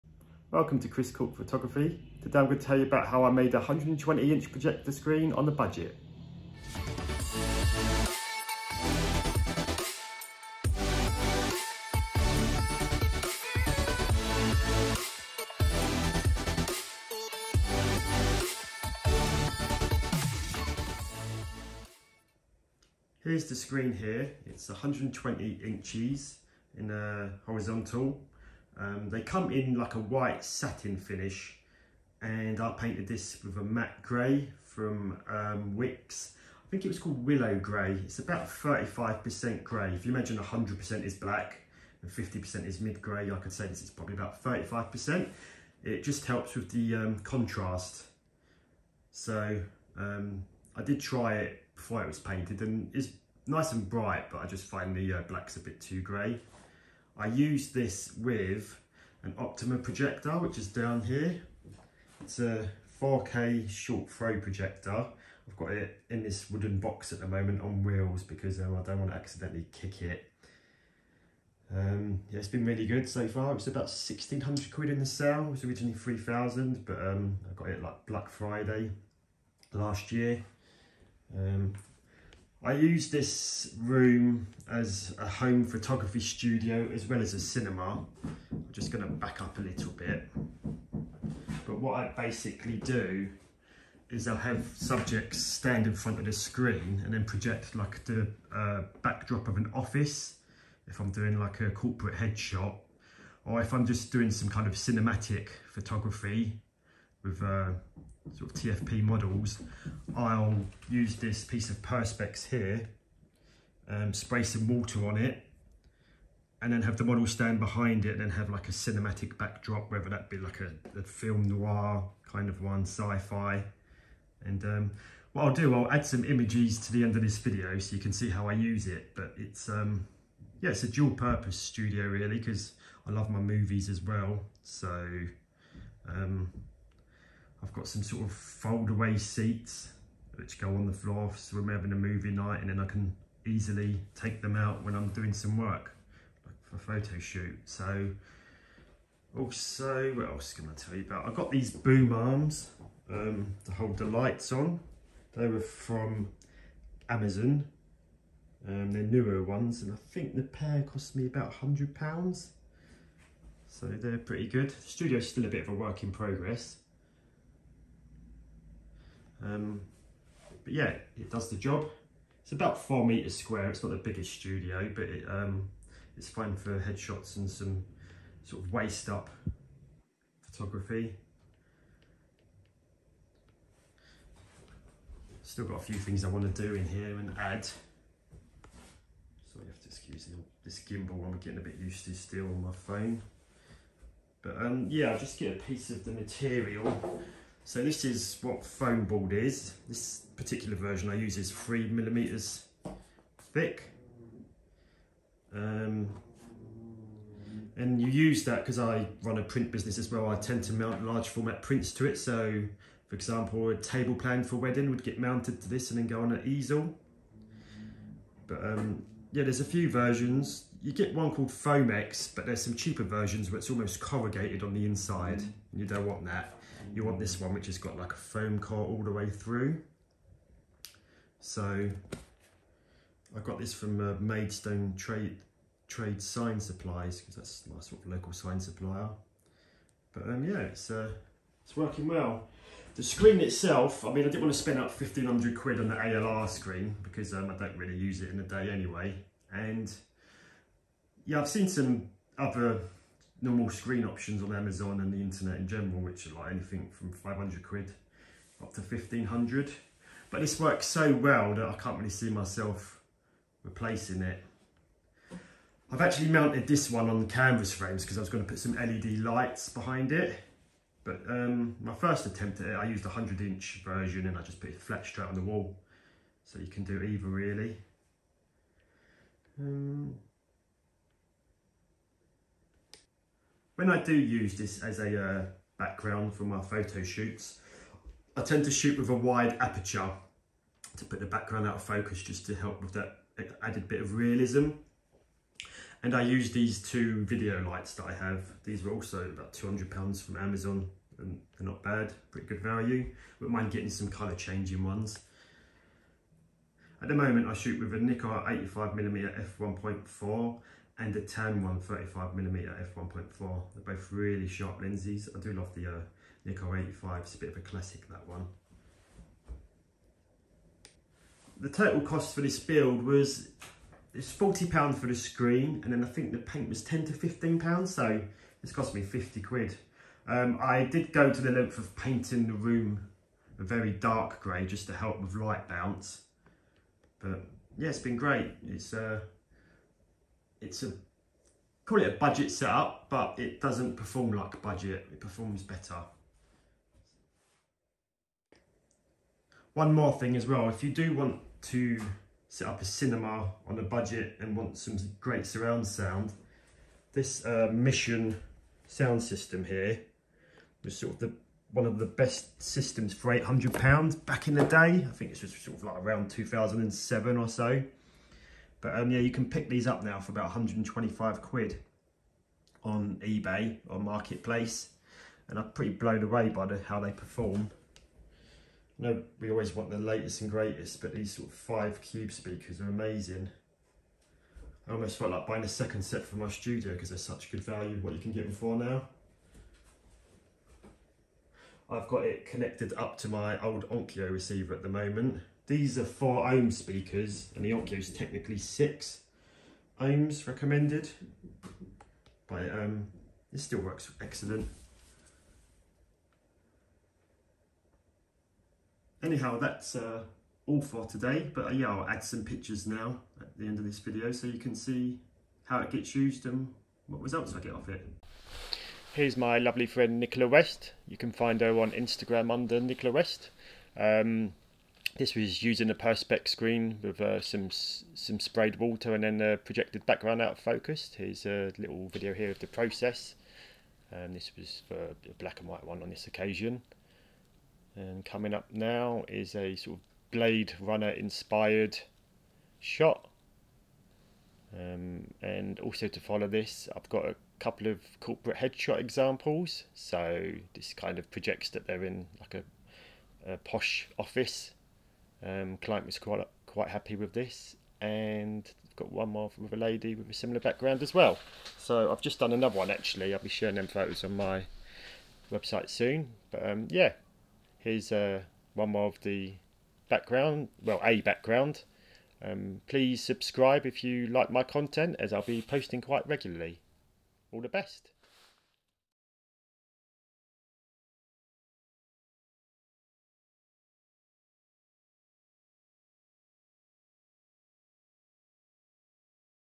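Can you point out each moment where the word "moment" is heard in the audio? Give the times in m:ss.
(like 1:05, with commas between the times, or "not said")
1:07, 5:07, 6:34.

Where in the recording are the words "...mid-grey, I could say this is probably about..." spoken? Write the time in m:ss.
0:42.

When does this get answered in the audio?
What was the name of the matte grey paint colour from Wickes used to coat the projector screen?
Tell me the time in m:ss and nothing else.
0:37.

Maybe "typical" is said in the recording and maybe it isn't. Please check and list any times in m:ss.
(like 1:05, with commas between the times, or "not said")
not said.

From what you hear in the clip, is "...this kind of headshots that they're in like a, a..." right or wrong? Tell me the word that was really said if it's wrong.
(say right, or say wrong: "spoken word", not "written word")
wrong: "projects", not "headshots".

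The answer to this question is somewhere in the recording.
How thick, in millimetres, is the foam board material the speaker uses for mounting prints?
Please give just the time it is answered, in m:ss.
3:21.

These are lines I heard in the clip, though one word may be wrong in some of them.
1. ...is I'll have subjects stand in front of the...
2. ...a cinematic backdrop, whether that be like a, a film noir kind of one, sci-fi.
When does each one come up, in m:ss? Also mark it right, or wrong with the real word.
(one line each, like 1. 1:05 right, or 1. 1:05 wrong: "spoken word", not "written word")
1. 1:34 right
2. 1:58 right.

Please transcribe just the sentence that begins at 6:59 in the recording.
Here's my lovely friend Nicola West.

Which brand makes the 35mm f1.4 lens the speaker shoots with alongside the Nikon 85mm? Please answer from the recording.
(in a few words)
Tamron.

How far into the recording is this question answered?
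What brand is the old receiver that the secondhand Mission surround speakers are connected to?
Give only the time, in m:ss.
6:33.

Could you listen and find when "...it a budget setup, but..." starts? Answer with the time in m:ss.
5:42.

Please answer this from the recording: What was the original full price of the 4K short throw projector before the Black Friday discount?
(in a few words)
3000.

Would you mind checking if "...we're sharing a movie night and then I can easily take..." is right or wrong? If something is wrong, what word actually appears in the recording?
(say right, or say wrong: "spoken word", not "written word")
wrong: "having", not "sharing".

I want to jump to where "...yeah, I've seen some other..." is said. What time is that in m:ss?
4:11.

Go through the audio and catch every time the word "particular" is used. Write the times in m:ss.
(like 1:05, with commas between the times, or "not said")
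3:20.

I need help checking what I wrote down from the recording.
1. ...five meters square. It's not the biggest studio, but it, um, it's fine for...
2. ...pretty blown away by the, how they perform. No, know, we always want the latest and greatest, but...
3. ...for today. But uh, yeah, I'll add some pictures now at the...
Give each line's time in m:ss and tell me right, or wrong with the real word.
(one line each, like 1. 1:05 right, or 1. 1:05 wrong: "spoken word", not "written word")
1. 2:52 wrong: "four", not "five"
2. 6:15 right
3. 6:50 right.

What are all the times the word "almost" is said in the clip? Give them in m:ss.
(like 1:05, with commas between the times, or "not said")
3:43, 6:24.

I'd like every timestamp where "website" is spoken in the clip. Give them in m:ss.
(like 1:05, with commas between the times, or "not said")
7:45.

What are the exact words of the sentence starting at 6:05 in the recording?
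I think this was sort of like around 2007 or so.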